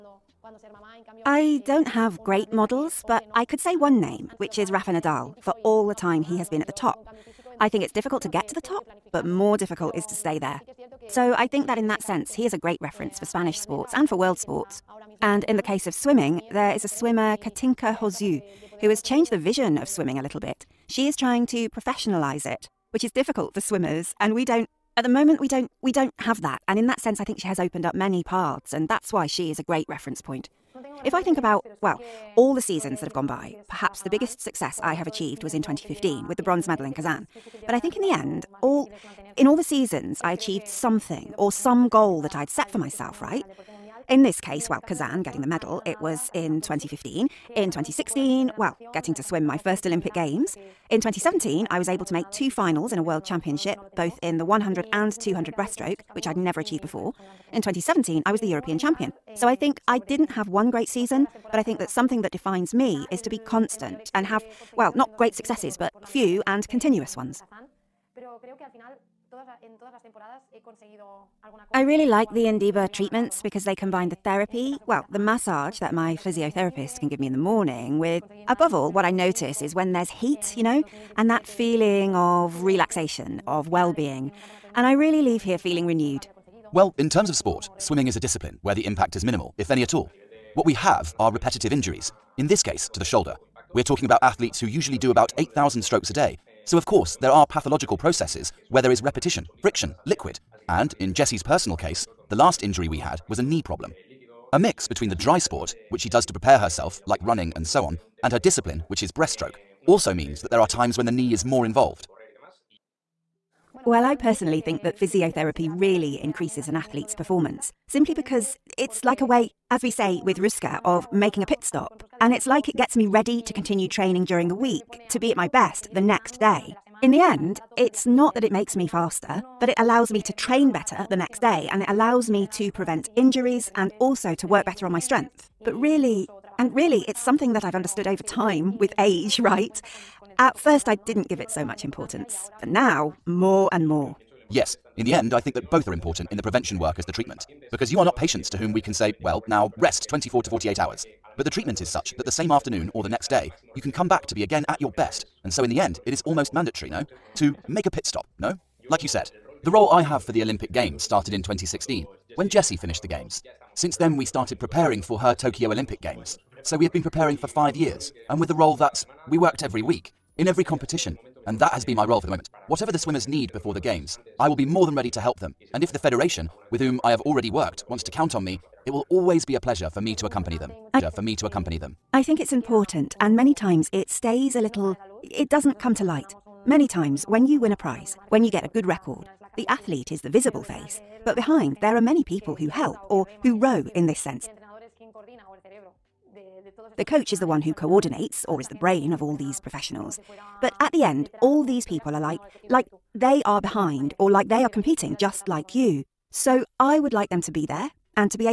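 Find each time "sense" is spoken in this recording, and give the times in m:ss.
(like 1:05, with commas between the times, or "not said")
0:12, 0:26, 3:14.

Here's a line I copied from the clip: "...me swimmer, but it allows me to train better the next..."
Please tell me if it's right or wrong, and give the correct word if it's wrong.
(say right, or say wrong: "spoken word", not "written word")
wrong: "faster", not "swimmer".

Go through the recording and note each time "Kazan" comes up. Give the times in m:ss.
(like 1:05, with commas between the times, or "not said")
0:36, 0:44.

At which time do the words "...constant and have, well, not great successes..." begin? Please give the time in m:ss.
1:03.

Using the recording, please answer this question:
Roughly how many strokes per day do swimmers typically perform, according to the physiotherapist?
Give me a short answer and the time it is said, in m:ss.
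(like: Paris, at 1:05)
8,000, at 1:35.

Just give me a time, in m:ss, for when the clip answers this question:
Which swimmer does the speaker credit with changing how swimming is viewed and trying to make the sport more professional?
0:17.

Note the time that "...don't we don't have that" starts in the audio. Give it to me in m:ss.
0:25.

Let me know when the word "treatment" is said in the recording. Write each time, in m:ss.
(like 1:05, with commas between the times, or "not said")
1:12, 2:27, 2:31.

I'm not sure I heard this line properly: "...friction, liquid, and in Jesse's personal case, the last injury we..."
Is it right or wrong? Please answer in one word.
right.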